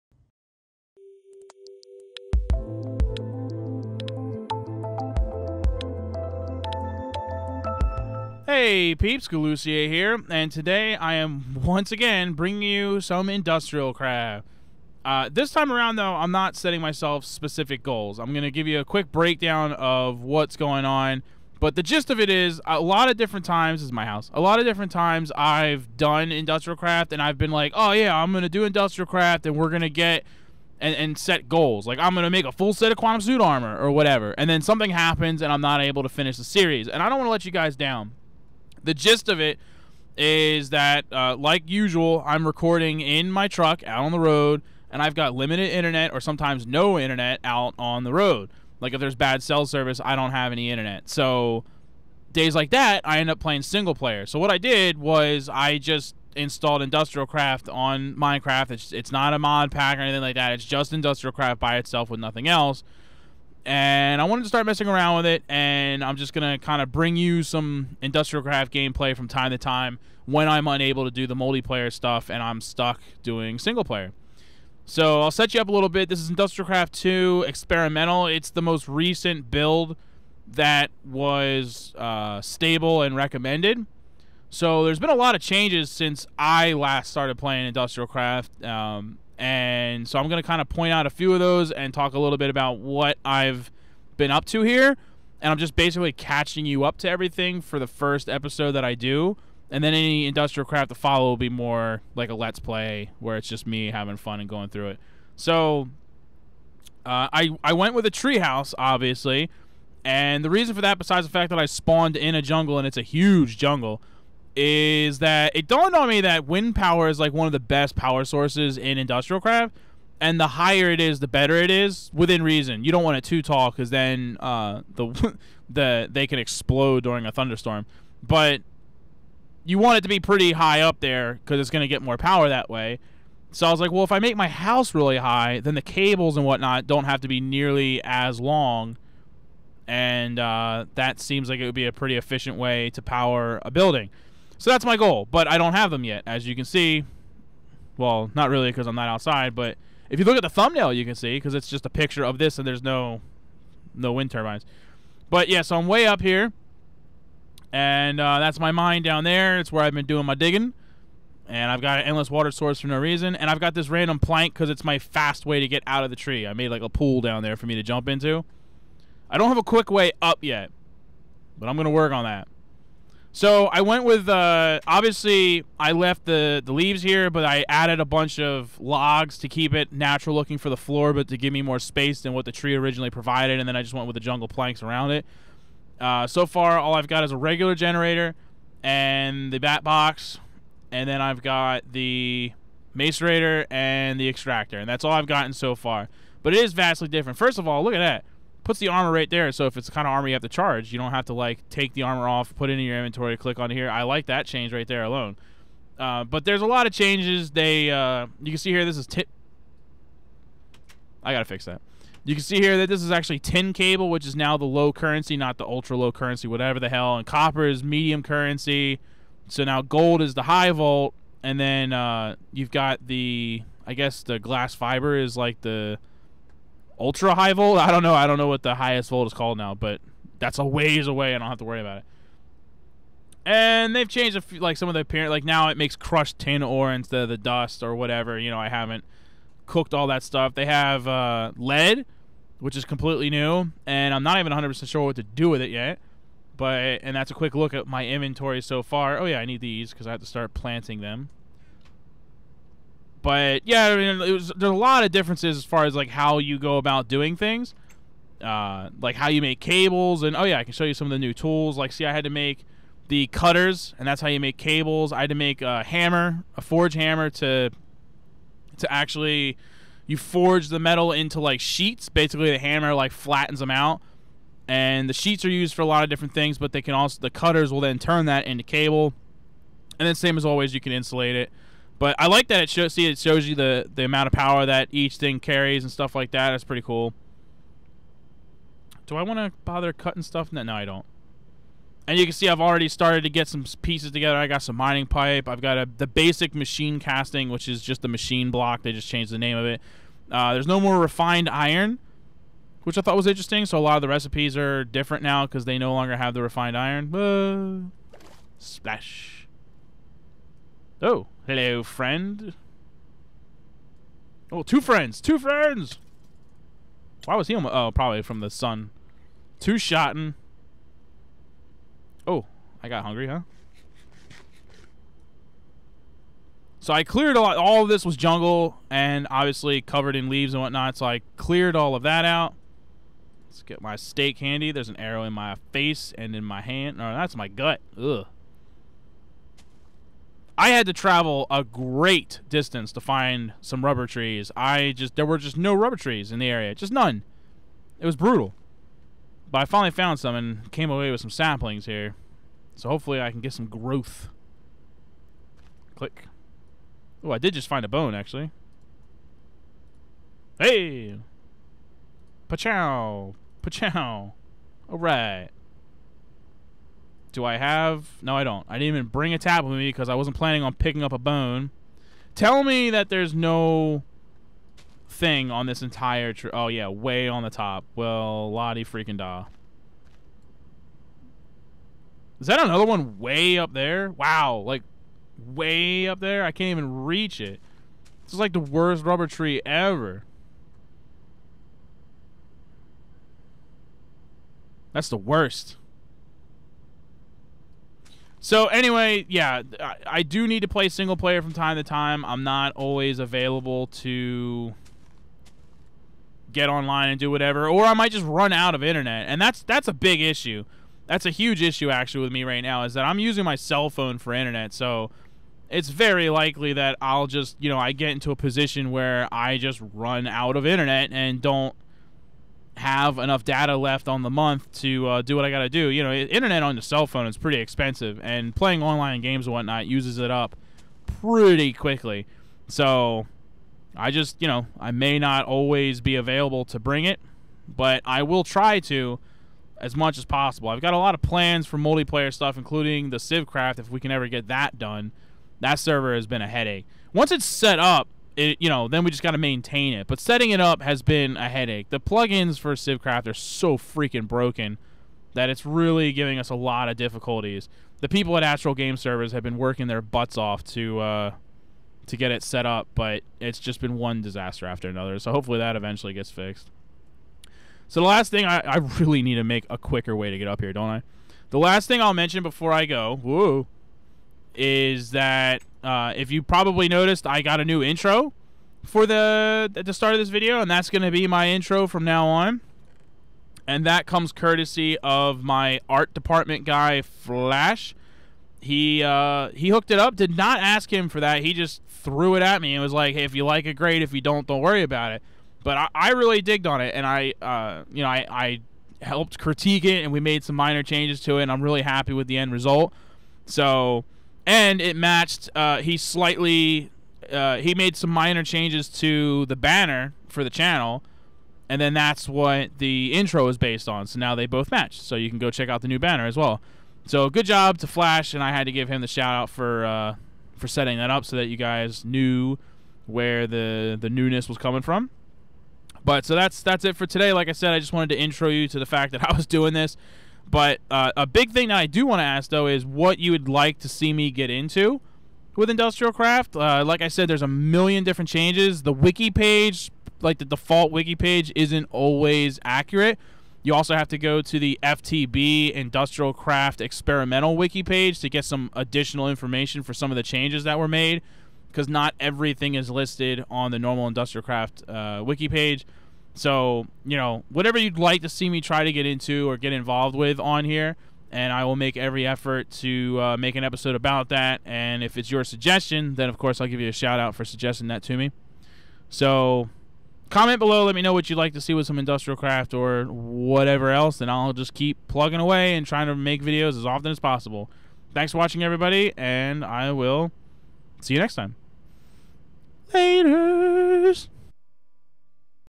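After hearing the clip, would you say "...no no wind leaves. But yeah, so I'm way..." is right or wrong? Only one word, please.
wrong.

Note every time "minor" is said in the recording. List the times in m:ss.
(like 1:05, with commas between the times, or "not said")
8:20, 8:28.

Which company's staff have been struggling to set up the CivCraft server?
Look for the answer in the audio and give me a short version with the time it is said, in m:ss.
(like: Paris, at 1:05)
Astral Game Servers, at 7:38.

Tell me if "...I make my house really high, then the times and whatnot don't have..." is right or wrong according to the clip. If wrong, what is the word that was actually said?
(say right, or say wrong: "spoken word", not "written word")
wrong: "cables", not "times".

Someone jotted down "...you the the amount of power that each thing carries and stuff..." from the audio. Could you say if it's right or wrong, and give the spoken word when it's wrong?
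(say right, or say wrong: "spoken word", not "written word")
right.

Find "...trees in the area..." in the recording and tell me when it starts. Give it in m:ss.
5:45.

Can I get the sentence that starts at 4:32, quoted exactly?
Basically, the hammer like flattens them out, and the sheets are used for a lot of different things.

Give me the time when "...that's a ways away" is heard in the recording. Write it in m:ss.
3:50.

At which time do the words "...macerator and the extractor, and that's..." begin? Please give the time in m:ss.
3:12.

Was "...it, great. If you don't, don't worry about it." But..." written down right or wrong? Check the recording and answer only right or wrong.
right.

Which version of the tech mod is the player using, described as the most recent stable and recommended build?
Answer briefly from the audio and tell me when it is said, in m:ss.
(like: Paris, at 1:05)
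Industrial Craft 2 Experimental, at 1:16.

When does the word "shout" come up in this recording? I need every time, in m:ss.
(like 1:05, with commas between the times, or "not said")
8:39, 9:26.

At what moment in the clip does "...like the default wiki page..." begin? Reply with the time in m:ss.
9:00.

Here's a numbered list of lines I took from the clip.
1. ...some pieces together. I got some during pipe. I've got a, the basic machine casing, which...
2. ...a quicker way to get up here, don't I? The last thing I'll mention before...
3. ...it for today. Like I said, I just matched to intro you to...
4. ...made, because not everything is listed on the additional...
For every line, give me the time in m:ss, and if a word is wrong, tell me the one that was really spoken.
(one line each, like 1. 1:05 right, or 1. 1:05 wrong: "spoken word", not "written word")
1. 4:53 wrong: "mining", not "during"
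2. 7:49 right
3. 8:46 wrong: "wanted", not "matched"
4. 9:10 wrong: "normal", not "additional".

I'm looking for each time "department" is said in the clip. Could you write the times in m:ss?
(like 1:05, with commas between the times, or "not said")
8:06.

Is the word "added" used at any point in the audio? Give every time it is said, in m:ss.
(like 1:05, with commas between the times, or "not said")
2:57.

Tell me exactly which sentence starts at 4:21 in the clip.
Like, see, I had to make the cutters, and that's how you make cables.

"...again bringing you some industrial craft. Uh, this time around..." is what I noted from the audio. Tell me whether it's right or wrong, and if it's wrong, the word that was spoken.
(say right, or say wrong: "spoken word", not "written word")
right.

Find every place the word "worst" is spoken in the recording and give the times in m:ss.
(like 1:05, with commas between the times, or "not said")
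6:28, 6:35.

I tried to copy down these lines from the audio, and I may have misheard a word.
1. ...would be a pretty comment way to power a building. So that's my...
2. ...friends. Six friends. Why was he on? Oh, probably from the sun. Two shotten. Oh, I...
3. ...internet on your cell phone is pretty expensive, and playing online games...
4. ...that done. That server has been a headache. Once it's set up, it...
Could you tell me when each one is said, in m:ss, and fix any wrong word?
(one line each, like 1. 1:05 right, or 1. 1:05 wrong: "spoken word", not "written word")
1. 2:21 wrong: "efficient", not "comment"
2. 5:14 wrong: "Two", not "Six"
3. 7:06 right
4. 7:24 right.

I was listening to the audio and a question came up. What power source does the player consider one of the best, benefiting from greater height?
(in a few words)
wind power.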